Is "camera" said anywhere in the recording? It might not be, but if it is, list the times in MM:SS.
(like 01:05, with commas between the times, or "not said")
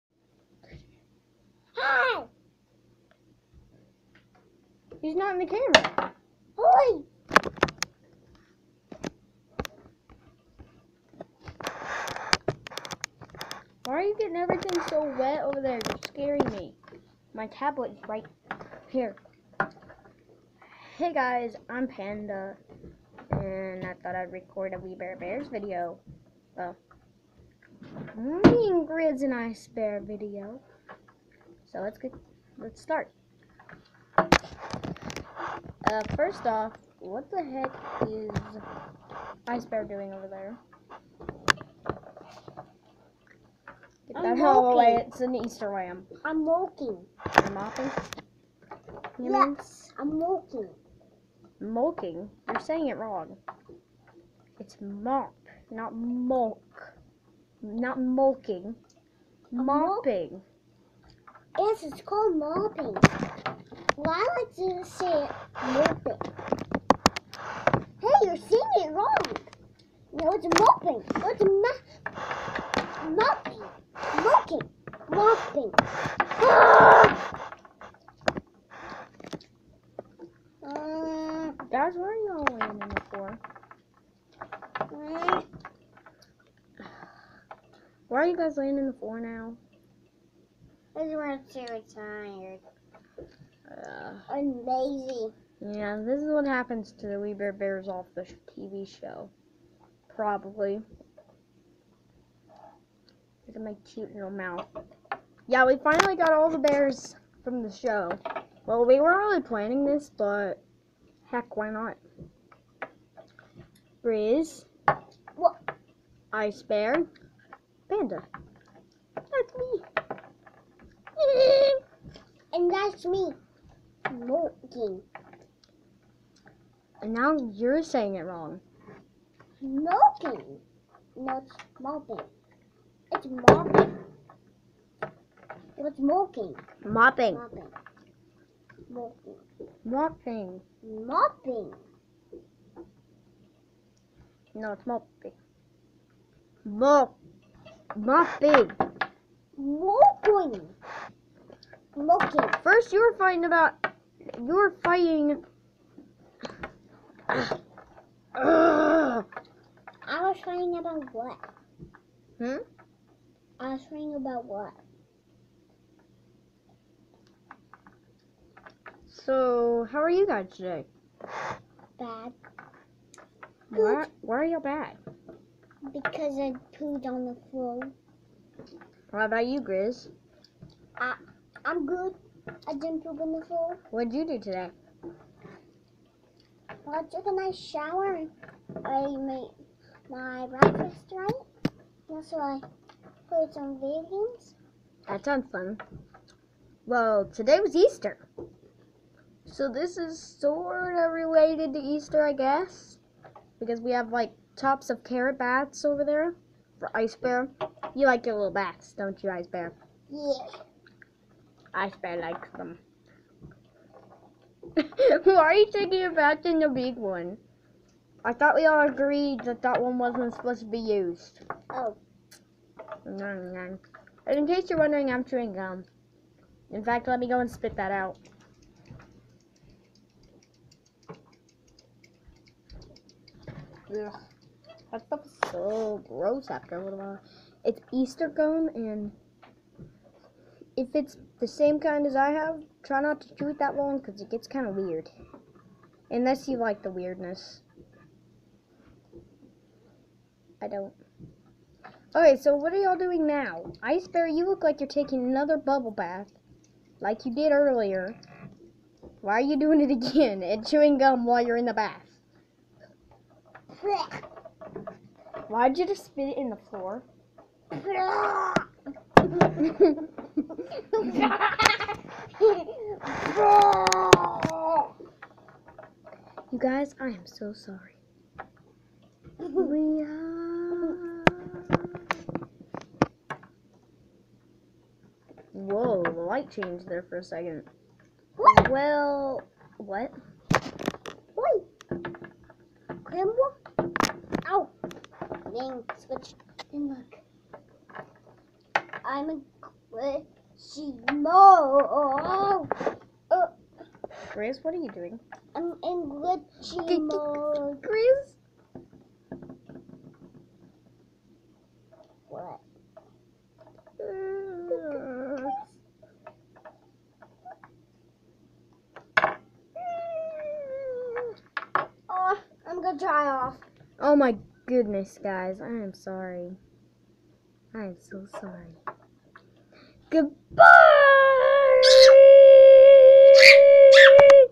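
00:05.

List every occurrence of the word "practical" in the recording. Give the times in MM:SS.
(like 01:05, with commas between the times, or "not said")
not said.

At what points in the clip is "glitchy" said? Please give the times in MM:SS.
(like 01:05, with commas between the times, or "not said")
04:59, 05:06.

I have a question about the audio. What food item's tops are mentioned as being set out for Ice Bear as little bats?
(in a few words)
Carrot.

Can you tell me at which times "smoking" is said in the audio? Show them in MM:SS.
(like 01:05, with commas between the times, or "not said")
02:04, 02:09.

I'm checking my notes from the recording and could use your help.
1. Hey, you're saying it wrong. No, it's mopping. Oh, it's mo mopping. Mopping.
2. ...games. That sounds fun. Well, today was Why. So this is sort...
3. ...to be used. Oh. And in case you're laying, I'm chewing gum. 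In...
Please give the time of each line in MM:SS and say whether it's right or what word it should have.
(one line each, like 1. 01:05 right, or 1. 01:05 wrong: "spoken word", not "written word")
1. 01:07 right
2. 03:14 wrong: "Easter", not "Why"
3. 03:40 wrong: "wondering", not "laying".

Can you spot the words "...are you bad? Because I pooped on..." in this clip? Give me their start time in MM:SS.
02:54.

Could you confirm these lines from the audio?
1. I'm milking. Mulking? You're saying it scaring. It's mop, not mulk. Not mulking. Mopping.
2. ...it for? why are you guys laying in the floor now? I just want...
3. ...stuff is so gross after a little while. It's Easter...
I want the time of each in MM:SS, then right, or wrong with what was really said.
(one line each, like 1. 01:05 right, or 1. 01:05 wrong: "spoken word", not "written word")
1. 00:49 wrong: "wrong", not "scaring"
2. 01:22 right
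3. 03:55 right.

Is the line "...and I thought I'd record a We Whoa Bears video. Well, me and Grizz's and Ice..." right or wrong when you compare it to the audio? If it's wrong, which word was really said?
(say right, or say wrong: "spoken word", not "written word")
wrong: "Bare", not "Whoa".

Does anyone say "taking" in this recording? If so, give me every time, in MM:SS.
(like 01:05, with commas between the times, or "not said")
03:35, 04:14.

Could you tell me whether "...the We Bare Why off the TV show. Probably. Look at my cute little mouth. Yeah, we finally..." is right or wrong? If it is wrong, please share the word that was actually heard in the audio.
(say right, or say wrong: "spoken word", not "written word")
wrong: "Bears", not "Why".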